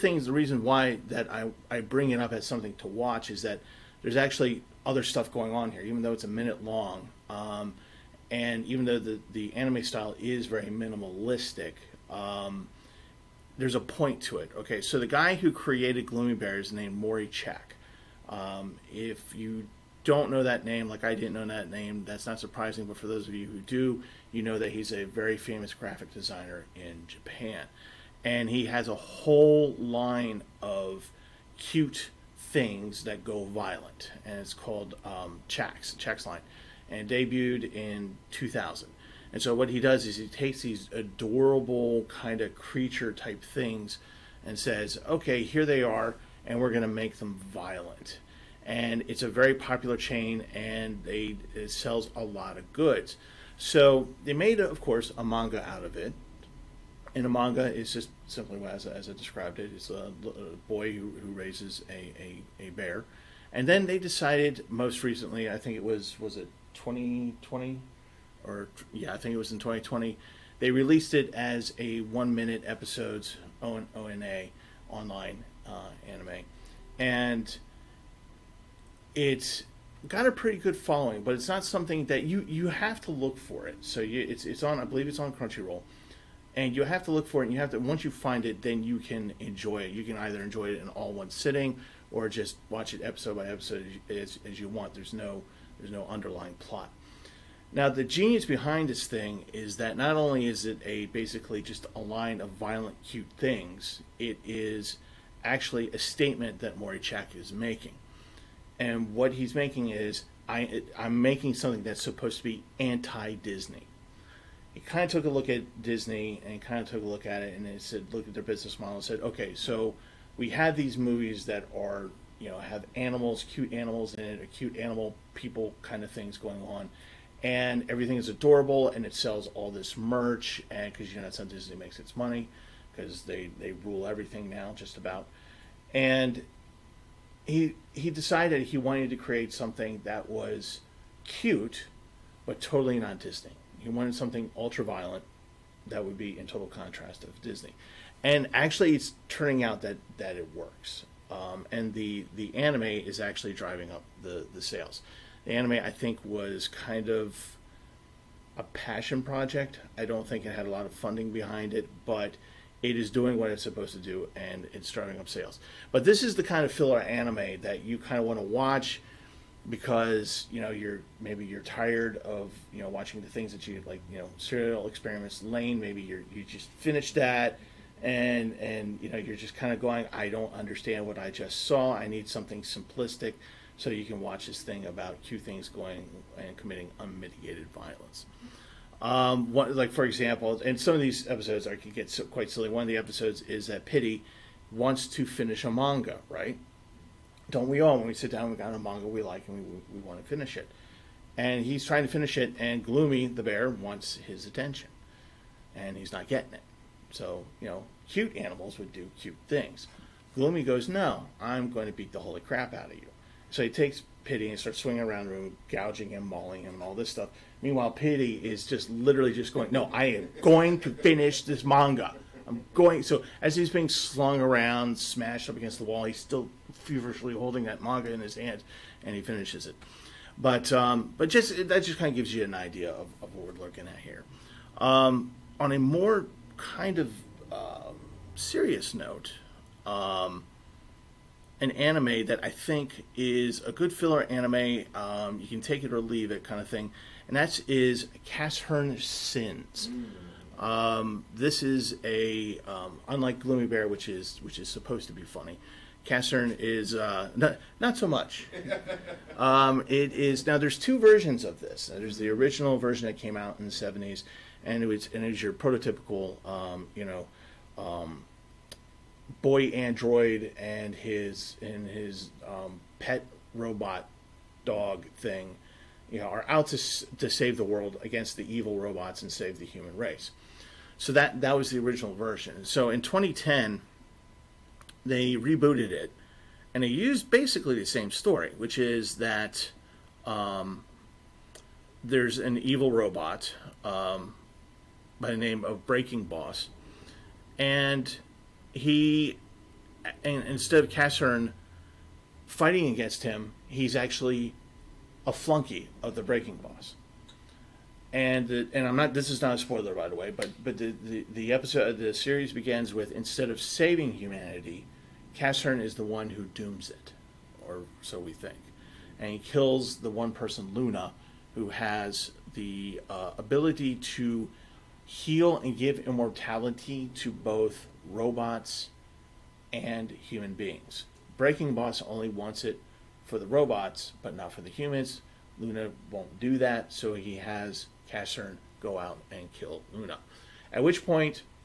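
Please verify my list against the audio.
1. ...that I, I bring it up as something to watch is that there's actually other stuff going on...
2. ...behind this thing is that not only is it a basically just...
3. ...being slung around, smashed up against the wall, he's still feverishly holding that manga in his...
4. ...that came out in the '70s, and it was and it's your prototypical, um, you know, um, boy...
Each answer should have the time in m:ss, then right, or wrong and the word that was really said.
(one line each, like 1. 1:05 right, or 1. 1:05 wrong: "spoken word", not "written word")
1. 0:01 right
2. 1:38 right
3. 3:43 right
4. 4:23 right.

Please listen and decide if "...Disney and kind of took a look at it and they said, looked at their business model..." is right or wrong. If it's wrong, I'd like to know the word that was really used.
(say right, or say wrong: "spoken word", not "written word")
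right.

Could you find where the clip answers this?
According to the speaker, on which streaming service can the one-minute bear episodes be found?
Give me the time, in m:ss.
1:25.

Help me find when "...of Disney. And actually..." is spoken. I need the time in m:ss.
2:27.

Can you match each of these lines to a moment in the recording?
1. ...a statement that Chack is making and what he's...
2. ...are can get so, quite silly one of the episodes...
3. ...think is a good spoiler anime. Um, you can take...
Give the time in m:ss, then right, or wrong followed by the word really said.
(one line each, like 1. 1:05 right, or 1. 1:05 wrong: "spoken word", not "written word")
1. 1:45 right
2. 3:11 right
3. 4:02 wrong: "filler", not "spoiler".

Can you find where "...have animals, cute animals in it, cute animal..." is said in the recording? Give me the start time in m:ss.
2:02.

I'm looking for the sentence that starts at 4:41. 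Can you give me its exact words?
So that that was the original version.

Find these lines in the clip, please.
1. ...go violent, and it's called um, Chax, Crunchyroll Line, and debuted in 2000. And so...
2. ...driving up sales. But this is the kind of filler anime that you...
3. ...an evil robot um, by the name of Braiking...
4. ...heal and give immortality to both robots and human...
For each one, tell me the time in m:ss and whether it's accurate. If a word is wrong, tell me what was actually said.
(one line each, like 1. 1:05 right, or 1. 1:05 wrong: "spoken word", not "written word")
1. 0:33 wrong: "Chax", not "Crunchyroll"
2. 2:44 right
3. 4:52 right
4. 5:25 right.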